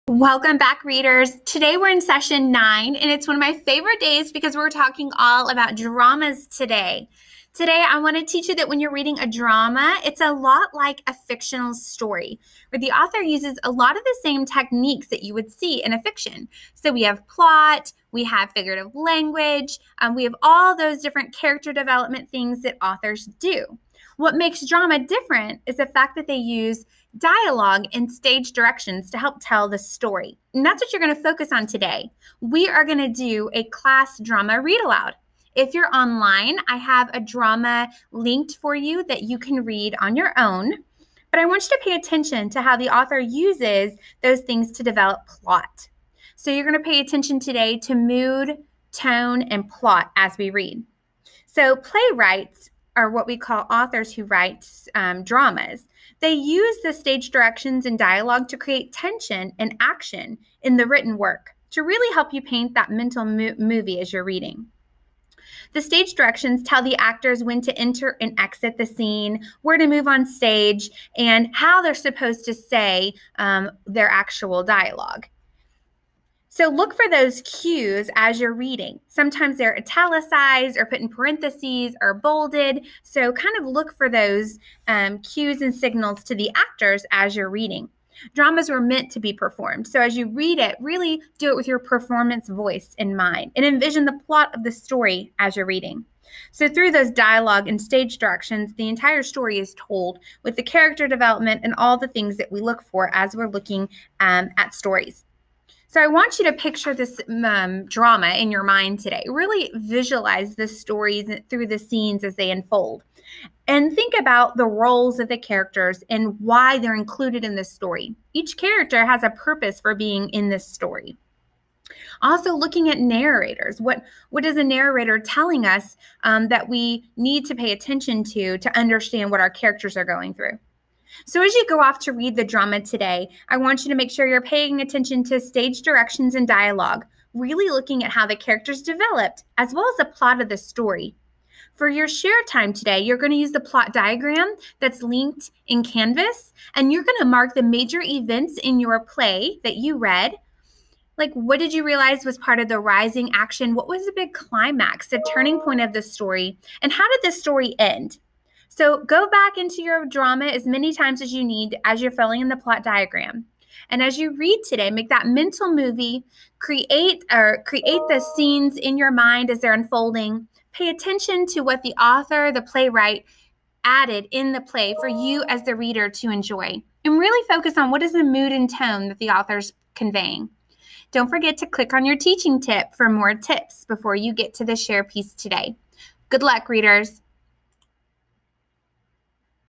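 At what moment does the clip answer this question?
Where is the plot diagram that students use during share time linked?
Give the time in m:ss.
2:25.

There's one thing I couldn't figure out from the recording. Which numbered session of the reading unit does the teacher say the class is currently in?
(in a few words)
9.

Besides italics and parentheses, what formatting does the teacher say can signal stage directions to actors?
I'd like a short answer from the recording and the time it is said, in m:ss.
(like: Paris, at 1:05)
Bolded, at 1:22.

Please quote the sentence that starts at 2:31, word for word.
Like, what did you realize was part of the rising action?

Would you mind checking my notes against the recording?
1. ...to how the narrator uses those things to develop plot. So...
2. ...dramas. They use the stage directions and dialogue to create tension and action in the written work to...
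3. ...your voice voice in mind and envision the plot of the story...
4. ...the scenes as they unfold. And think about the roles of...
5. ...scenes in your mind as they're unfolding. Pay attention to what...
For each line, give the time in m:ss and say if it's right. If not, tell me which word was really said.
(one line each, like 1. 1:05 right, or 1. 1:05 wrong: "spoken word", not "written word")
1. 0:42 wrong: "author", not "narrator"
2. 0:55 right
3. 1:31 wrong: "performance", not "voice"
4. 1:51 right
5. 2:48 right.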